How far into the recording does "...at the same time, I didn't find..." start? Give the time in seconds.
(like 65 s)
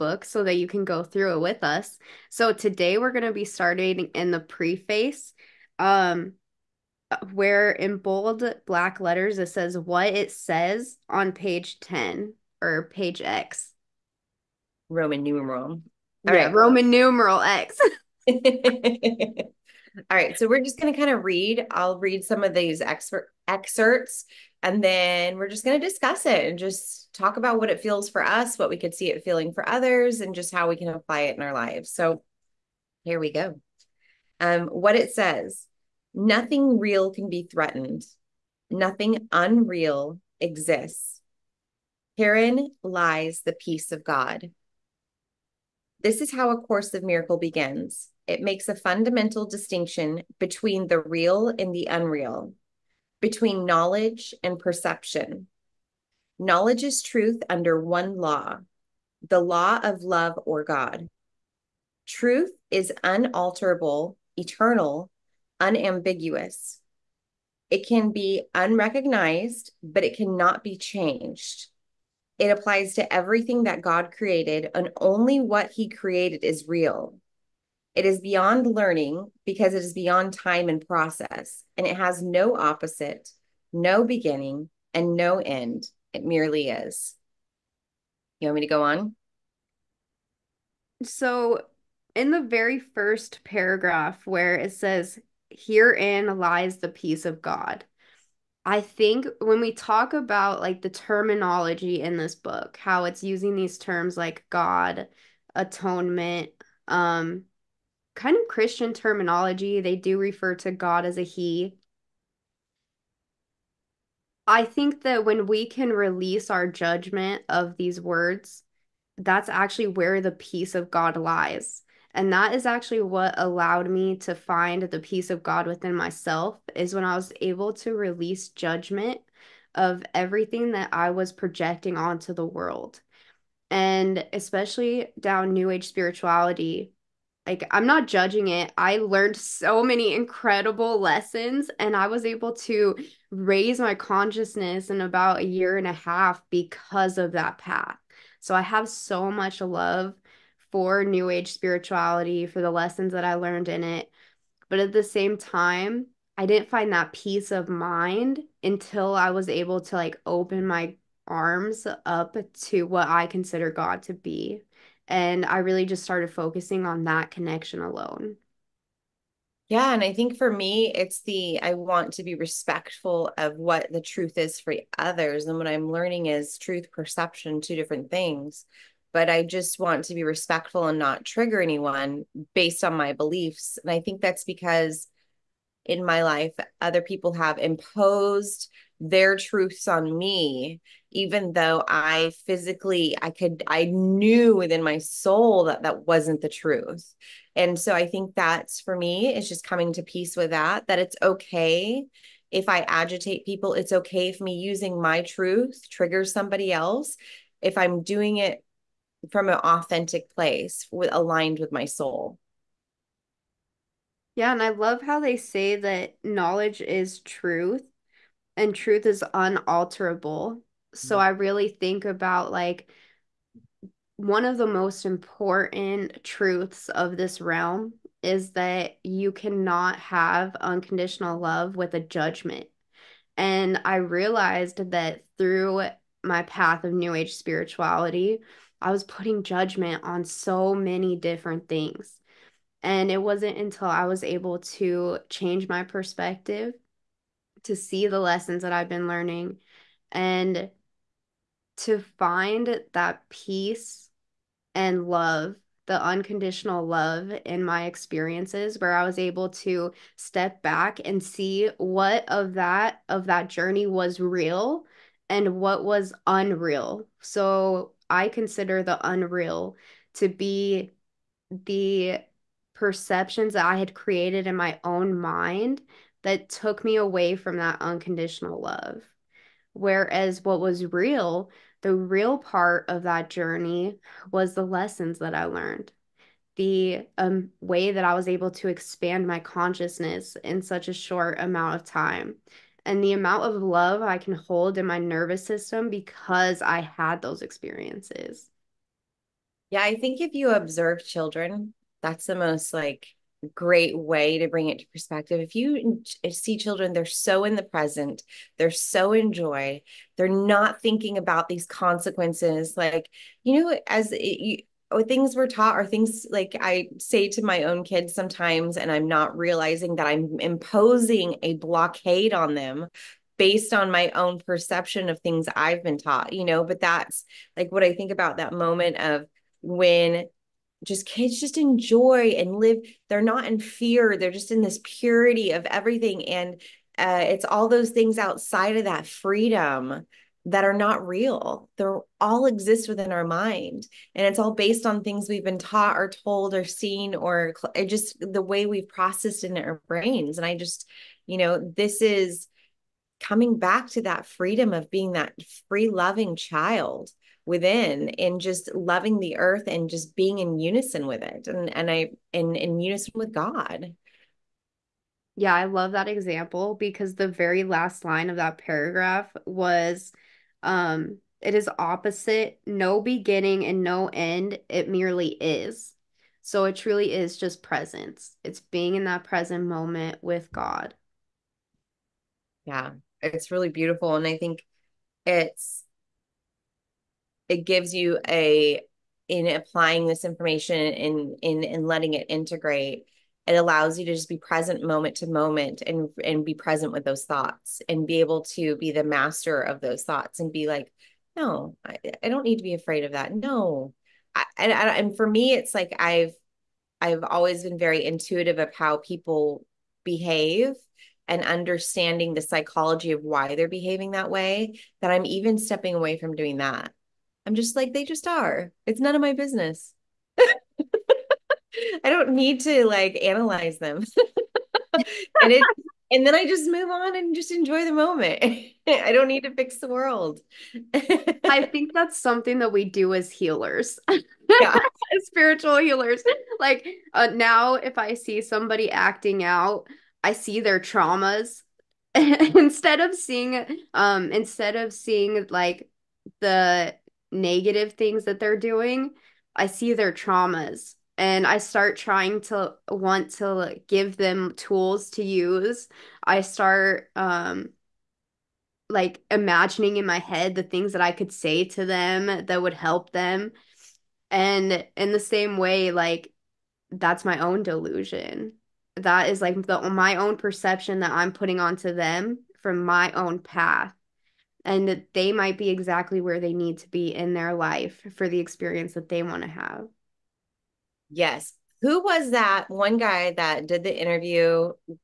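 154 s.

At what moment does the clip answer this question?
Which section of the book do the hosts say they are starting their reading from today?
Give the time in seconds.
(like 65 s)
4 s.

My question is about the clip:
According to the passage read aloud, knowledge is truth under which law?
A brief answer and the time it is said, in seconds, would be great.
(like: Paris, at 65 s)
The law of love, at 59 s.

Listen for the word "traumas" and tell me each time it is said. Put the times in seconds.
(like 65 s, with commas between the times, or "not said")
440 s, 450 s.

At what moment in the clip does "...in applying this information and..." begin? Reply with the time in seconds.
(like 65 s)
389 s.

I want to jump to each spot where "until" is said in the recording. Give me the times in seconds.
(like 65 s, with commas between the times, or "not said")
158 s, 243 s.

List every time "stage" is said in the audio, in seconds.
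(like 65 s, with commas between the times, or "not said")
not said.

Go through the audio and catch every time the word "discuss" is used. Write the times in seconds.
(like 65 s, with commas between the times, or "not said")
25 s.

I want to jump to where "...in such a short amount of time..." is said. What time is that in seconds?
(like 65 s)
290 s.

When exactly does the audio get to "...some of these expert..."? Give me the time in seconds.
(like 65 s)
22 s.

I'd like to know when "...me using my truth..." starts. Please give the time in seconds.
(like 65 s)
204 s.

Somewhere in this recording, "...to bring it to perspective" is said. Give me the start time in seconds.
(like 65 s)
304 s.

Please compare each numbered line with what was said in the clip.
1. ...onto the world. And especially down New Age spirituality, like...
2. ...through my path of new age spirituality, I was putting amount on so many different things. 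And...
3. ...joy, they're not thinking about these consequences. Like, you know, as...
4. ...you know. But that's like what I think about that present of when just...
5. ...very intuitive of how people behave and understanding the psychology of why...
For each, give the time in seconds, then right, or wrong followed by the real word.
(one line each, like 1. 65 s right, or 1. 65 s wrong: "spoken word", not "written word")
1. 131 s right
2. 235 s wrong: "judgment", not "amount"
3. 309 s right
4. 326 s wrong: "moment", not "present"
5. 407 s right.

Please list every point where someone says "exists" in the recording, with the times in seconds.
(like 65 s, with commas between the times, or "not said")
40 s, 342 s.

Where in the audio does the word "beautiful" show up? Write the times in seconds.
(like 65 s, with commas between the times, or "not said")
383 s.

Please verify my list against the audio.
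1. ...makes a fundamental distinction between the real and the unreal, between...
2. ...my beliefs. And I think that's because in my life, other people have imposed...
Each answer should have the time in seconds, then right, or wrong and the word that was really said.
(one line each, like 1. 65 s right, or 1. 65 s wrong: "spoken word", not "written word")
1. 48 s right
2. 182 s right.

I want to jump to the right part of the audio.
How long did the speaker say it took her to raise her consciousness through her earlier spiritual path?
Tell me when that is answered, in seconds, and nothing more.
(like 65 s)
145 s.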